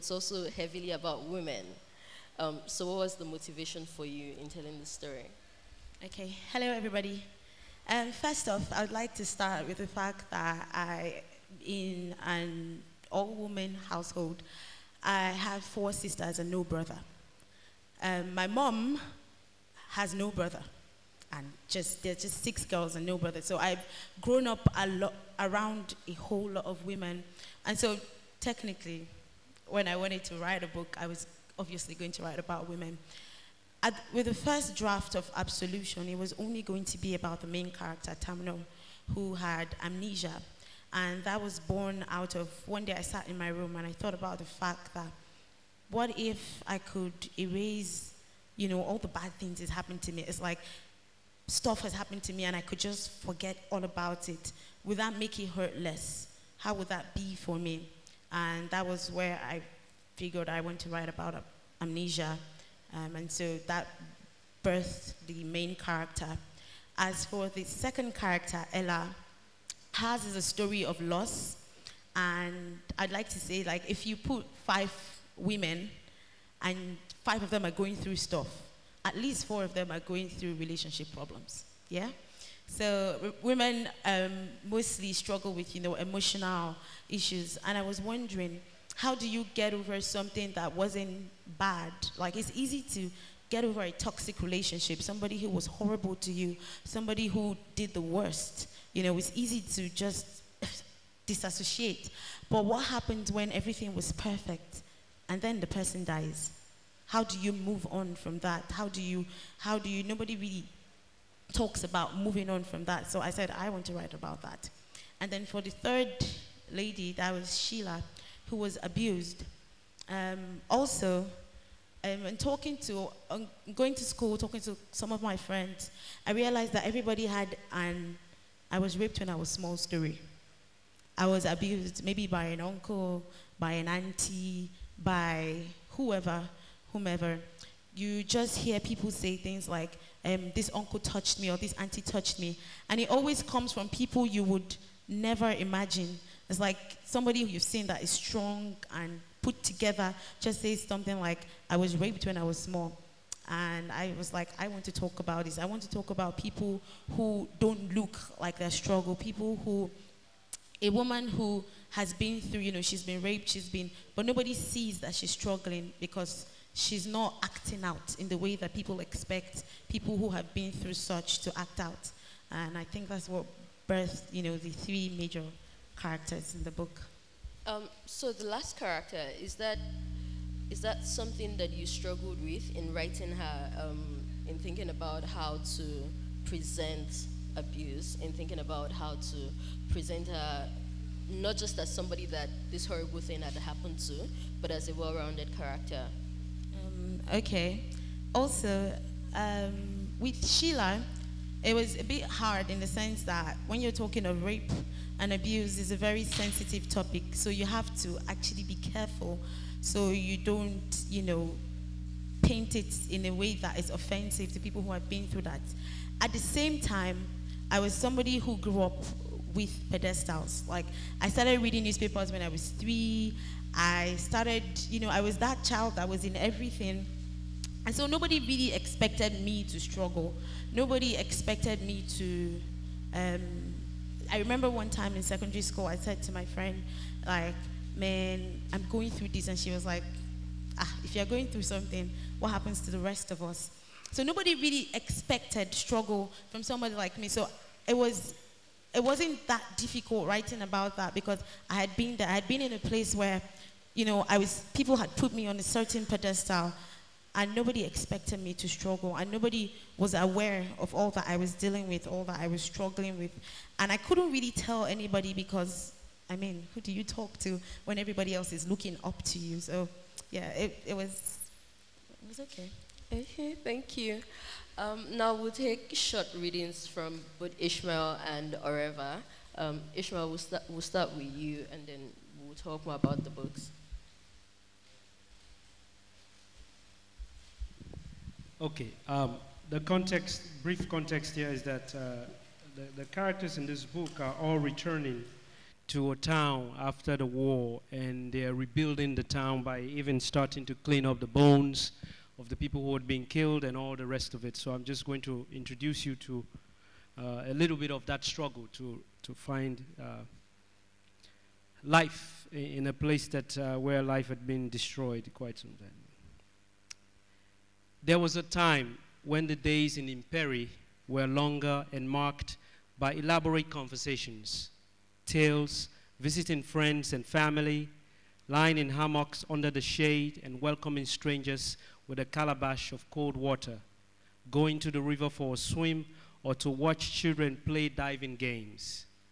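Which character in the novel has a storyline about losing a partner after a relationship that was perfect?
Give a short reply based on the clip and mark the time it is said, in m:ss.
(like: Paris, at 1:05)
Ella, at 1:08.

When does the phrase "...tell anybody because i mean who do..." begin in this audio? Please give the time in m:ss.
4:24.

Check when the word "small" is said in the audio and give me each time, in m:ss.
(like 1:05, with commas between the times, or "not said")
2:09, 2:32.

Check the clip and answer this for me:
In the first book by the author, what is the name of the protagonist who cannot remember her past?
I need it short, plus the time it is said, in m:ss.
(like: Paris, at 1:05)
Tamno, at 0:38.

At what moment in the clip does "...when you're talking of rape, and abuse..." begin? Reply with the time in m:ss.
3:23.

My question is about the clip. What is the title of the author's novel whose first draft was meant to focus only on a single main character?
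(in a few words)
Absolution.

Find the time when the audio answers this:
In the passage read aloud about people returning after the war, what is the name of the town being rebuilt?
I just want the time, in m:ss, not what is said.
5:20.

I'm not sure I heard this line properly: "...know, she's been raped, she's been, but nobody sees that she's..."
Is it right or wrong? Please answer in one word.
right.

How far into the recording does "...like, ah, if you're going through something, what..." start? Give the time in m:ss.
3:59.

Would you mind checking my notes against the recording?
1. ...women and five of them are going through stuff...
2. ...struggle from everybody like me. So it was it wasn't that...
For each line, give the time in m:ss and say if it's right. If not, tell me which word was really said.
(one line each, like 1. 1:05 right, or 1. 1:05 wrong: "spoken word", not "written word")
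1. 1:15 right
2. 4:05 wrong: "somebody", not "everybody".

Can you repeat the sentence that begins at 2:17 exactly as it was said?
You just hear people say things like, um, this uncle touched me or this auntie touched me.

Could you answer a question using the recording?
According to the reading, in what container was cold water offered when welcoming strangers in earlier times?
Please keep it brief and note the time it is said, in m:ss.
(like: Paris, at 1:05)
Calabash, at 5:32.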